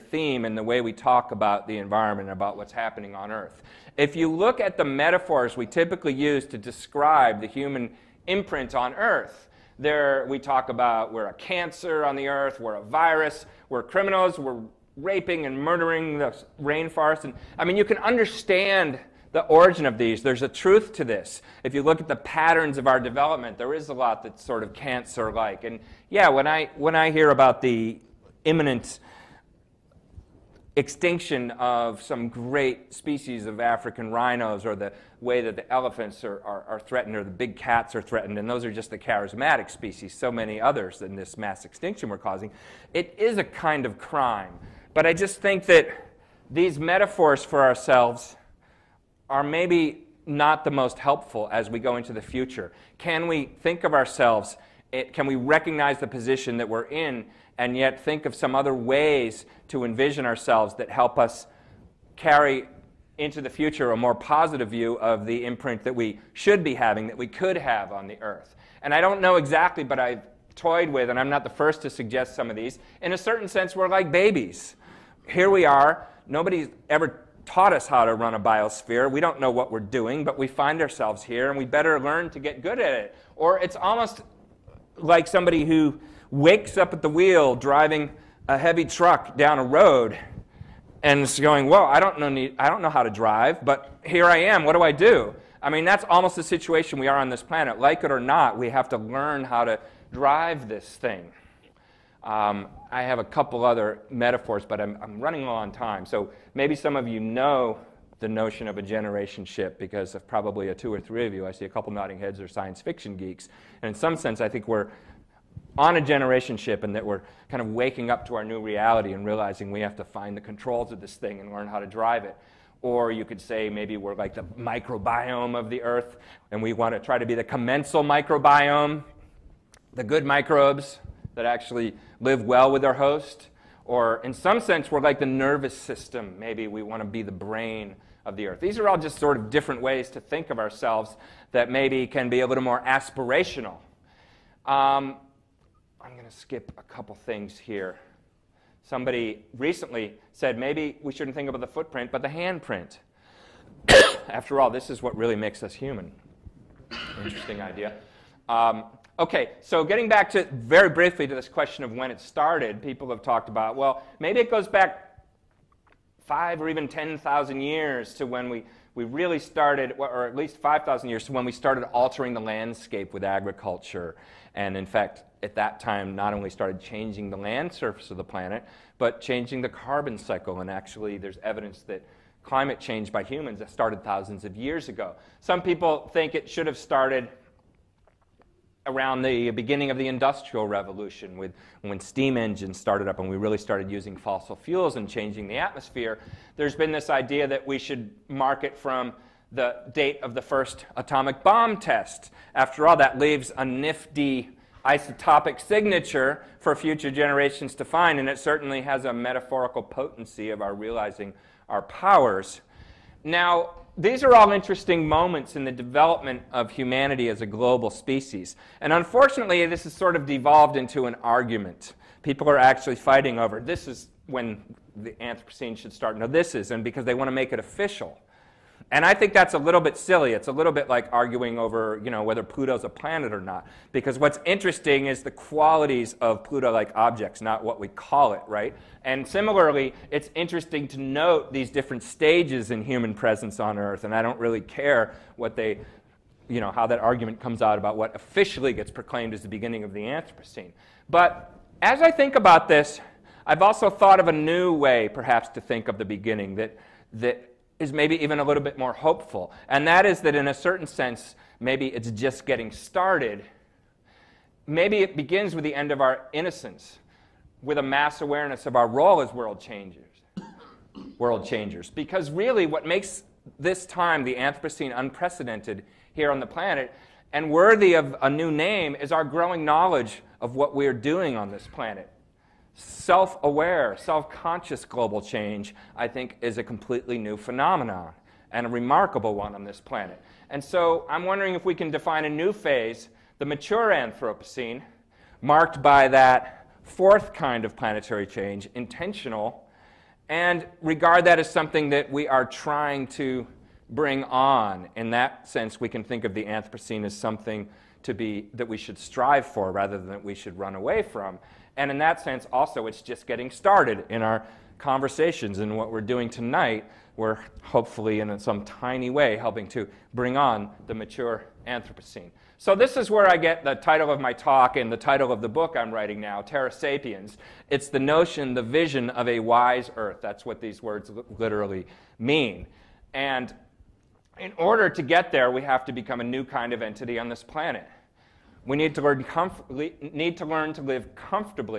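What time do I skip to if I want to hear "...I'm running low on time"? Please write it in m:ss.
1:45.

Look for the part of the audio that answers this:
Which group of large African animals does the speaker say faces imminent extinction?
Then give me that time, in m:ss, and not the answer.
0:33.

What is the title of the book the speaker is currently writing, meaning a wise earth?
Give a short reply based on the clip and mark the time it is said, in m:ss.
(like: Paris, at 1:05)
Terra Sapiens, at 5:26.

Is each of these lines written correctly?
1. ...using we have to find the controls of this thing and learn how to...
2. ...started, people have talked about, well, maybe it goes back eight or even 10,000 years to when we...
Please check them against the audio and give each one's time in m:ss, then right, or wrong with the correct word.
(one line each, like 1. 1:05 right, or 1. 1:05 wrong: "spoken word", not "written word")
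1. 1:59 wrong: "realizing", not "using"
2. 2:42 wrong: "five", not "eight".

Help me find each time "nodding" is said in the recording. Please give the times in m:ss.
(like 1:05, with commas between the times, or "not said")
1:51.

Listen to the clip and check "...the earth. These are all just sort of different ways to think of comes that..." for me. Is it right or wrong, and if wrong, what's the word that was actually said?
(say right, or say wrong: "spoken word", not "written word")
wrong: "ourselves", not "comes".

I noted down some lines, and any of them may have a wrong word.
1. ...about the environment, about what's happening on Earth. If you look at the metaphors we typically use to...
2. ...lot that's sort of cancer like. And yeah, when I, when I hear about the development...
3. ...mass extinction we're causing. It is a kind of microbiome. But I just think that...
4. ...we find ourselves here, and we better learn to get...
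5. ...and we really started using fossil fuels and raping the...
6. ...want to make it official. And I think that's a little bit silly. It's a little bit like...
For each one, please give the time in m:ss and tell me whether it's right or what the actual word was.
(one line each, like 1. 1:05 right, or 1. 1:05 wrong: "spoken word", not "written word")
1. 0:01 right
2. 0:23 wrong: "imminent", not "development"
3. 0:41 wrong: "crime", not "microbiome"
4. 1:20 right
5. 3:13 wrong: "changing", not "raping"
6. 3:47 right.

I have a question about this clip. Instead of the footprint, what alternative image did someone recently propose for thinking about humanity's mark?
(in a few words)
the handprint.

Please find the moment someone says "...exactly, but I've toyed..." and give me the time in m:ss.
1:09.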